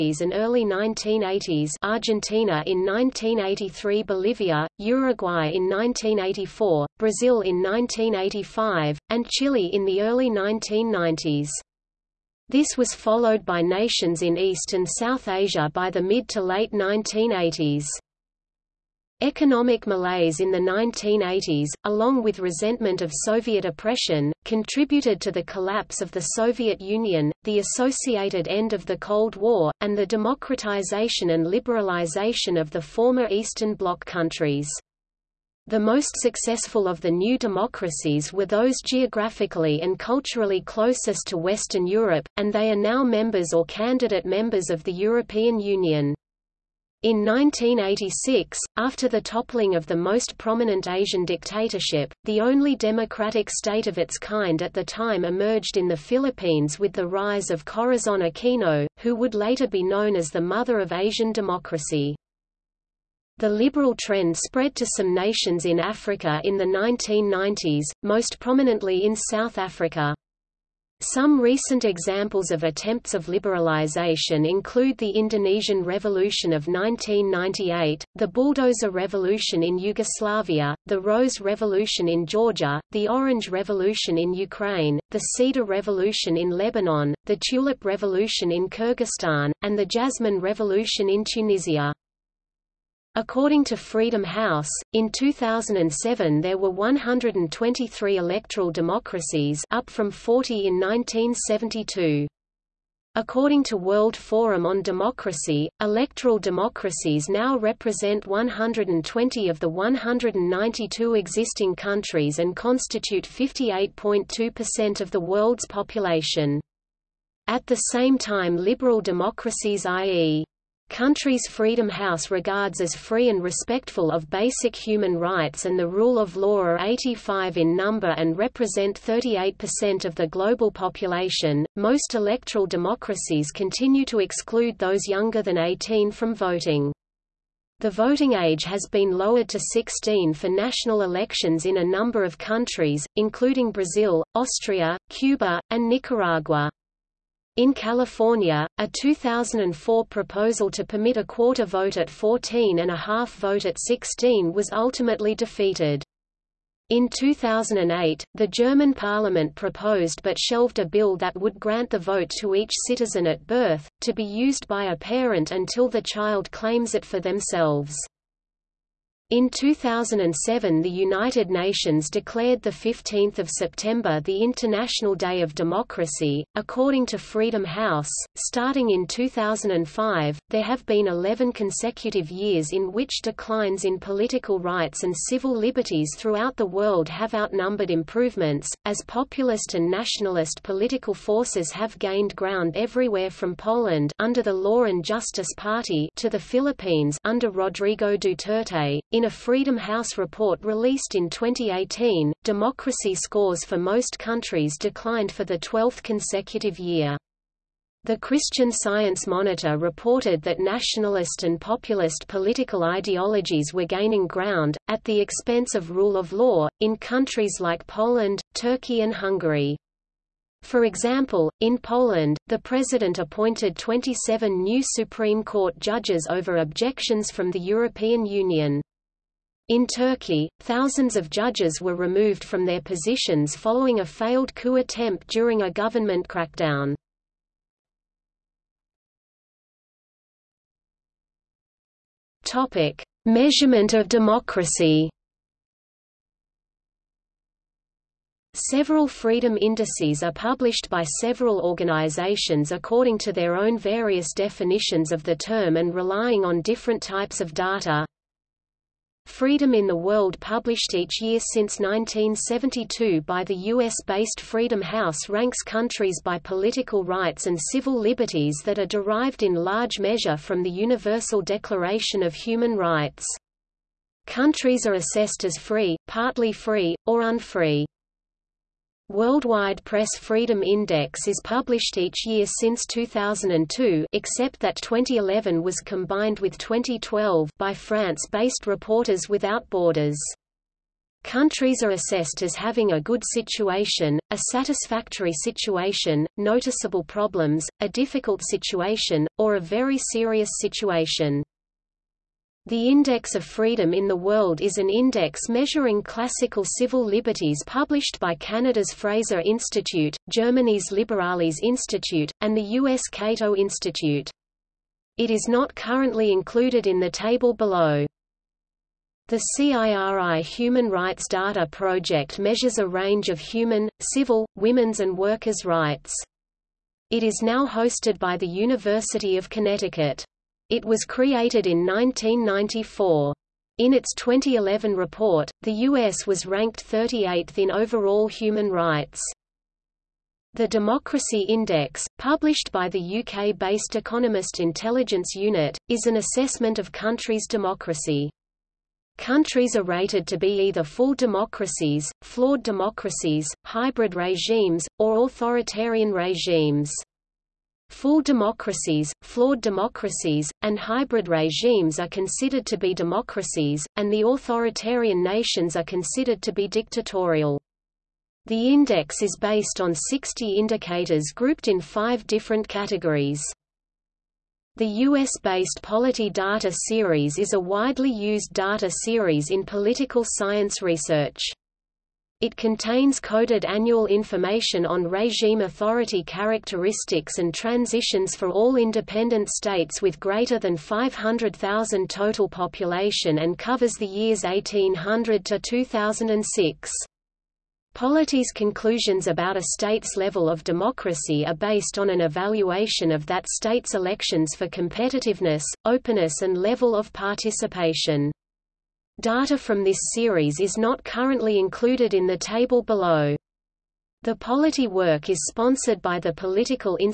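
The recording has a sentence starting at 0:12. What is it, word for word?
This was followed by nations in East and South Asia by the mid to late 1980s.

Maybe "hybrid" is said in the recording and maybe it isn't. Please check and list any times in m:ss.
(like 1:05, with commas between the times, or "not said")
5:53, 6:00.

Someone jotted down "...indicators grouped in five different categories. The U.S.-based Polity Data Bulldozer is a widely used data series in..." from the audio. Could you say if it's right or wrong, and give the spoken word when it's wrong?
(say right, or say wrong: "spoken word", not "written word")
wrong: "Series", not "Bulldozer".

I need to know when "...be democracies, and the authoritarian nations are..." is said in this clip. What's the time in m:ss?
6:02.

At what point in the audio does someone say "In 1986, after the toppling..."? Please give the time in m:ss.
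0:47.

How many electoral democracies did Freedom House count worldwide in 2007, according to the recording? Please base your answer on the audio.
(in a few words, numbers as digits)
123.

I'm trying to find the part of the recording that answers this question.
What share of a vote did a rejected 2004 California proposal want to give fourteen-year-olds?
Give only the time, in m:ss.
2:31.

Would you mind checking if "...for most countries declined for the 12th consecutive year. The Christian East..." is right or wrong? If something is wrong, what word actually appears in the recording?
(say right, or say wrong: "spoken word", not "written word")
wrong: "Science", not "East".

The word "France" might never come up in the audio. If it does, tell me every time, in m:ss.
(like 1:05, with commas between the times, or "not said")
4:47.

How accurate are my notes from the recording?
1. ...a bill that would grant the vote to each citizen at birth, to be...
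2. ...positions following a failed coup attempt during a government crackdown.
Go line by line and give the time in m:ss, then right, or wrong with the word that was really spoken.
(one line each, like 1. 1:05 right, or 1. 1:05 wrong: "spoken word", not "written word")
1. 2:40 right
2. 3:52 right.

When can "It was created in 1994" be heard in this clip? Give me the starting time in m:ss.
5:30.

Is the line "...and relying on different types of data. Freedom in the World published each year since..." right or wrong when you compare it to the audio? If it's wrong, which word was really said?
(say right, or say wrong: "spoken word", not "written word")
right.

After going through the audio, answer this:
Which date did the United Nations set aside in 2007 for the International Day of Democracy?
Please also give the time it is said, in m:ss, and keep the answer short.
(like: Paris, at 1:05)
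15 September, at 2:52.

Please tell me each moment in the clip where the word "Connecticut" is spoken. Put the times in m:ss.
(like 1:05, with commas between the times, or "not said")
5:29.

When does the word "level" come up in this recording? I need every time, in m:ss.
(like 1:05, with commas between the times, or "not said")
6:40, 6:46.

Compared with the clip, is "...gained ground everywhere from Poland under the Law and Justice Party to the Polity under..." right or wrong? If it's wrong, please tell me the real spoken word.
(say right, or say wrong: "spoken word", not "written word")
wrong: "Philippines", not "Polity".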